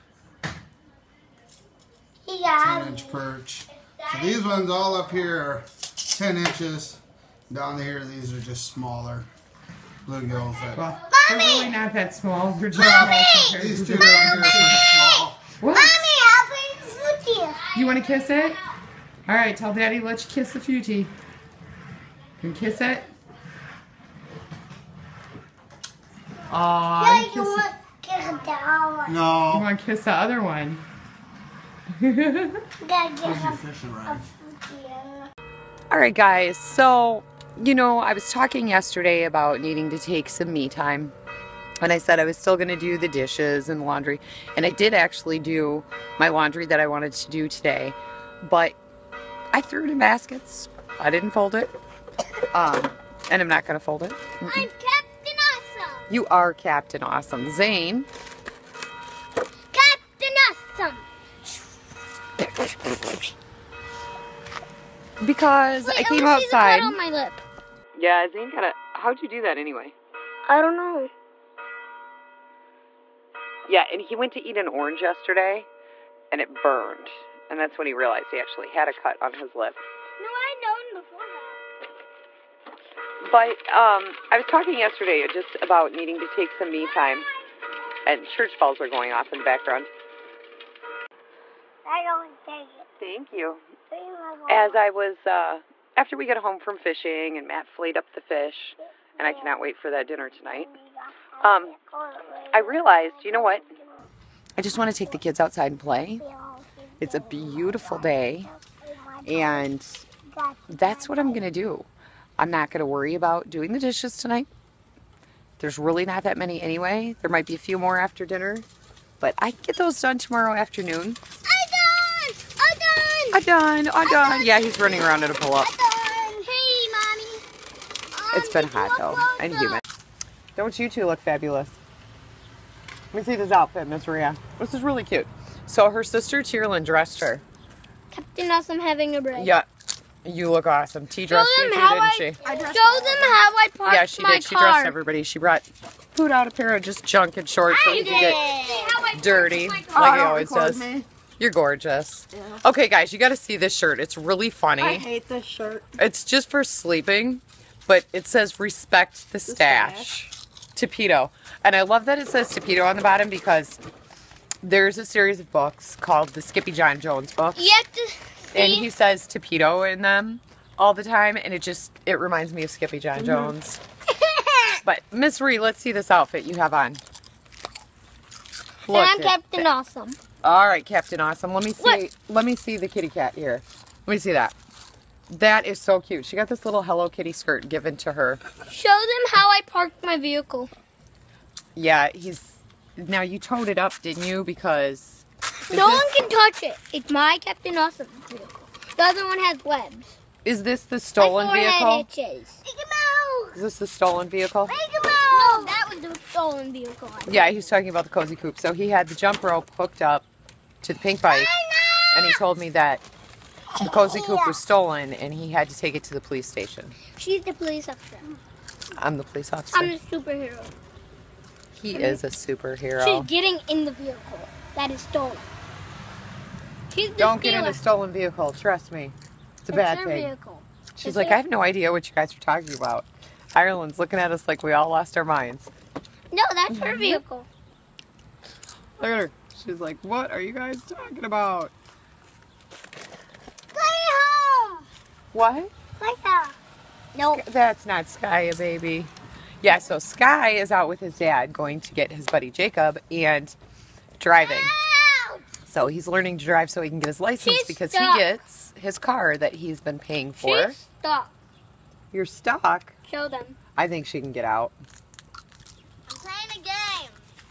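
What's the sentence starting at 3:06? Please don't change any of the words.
She got this little Hello Kitty skirt given to her.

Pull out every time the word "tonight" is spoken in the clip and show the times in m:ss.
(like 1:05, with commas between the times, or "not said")
1:40, 1:54.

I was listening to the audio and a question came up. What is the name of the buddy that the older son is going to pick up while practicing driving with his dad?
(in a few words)
Jacob.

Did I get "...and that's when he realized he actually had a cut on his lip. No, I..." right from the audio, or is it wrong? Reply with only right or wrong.
right.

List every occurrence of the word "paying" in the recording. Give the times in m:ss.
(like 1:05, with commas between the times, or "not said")
4:19.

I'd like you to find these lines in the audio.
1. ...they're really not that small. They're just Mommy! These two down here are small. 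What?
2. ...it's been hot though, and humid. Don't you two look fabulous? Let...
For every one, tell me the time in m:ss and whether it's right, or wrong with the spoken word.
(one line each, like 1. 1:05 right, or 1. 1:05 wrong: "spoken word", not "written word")
1. 0:11 right
2. 2:08 right.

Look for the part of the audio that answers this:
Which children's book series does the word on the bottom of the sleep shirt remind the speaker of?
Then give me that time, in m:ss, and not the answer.
2:46.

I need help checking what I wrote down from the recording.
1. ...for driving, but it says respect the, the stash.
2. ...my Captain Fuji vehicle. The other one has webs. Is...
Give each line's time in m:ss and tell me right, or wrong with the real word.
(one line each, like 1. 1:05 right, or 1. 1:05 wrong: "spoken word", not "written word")
1. 2:36 wrong: "sleeping", not "driving"
2. 3:17 wrong: "Awesome", not "Fuji".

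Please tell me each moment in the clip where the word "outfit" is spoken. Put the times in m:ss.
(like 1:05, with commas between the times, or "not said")
2:13, 2:56.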